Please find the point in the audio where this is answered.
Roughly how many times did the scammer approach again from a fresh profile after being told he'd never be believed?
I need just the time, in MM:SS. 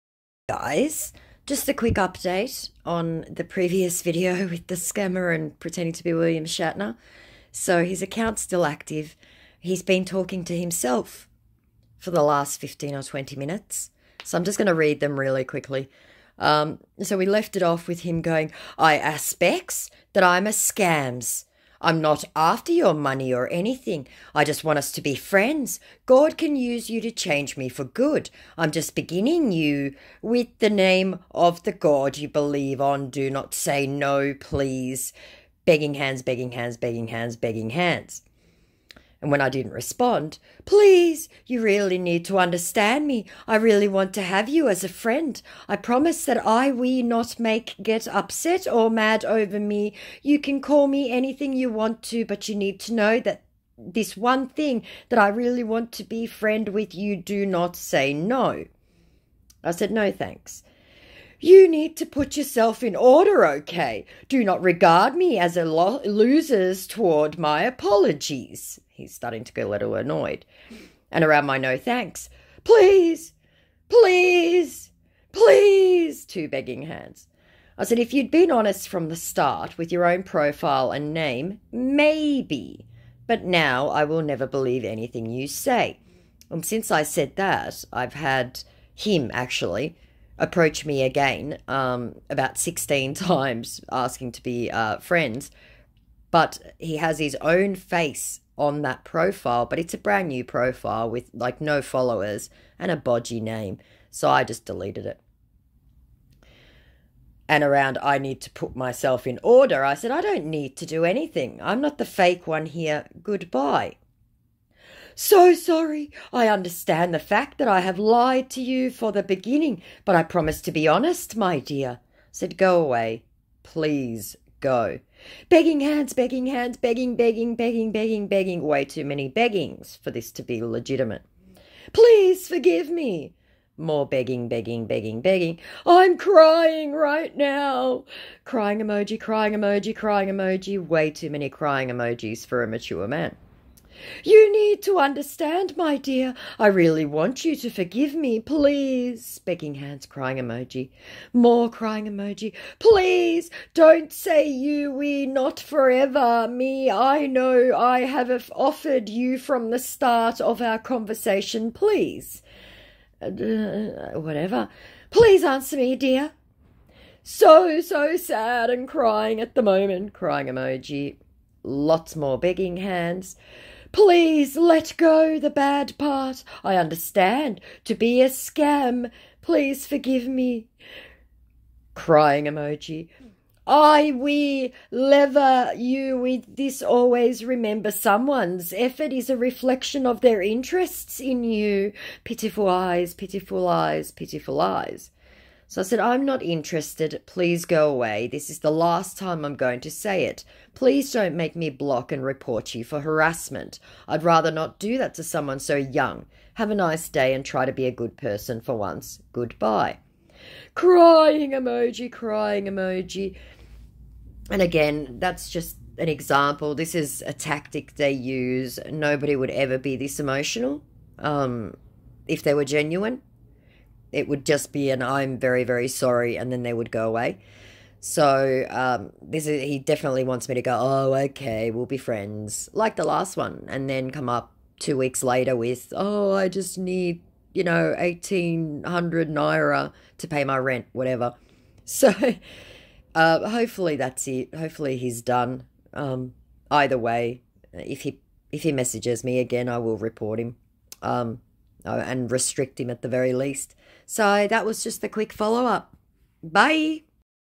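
01:32.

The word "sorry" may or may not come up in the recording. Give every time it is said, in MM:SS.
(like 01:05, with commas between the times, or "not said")
01:55, 03:45.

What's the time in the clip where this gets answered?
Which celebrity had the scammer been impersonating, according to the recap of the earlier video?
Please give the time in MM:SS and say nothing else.
00:06.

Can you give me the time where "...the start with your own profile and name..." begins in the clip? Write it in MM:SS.
01:19.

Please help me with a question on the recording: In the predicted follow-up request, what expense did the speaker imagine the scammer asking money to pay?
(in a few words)
rent.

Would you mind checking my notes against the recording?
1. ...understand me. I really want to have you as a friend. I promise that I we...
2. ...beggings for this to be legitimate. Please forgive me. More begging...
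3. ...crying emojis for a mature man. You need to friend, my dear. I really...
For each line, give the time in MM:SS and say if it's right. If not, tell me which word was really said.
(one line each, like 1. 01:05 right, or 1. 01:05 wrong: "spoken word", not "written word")
1. 00:42 right
2. 02:09 right
3. 02:21 wrong: "understand", not "friend".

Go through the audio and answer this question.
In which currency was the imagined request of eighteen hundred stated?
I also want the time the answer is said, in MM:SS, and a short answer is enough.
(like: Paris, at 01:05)
naira, at 03:59.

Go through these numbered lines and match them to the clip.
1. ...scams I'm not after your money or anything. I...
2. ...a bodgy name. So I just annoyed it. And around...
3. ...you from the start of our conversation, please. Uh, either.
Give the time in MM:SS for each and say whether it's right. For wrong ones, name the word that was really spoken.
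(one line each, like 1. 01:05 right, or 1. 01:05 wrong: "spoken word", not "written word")
1. 00:20 right
2. 01:42 wrong: "deleted", not "annoyed"
3. 02:39 wrong: "whatever", not "either".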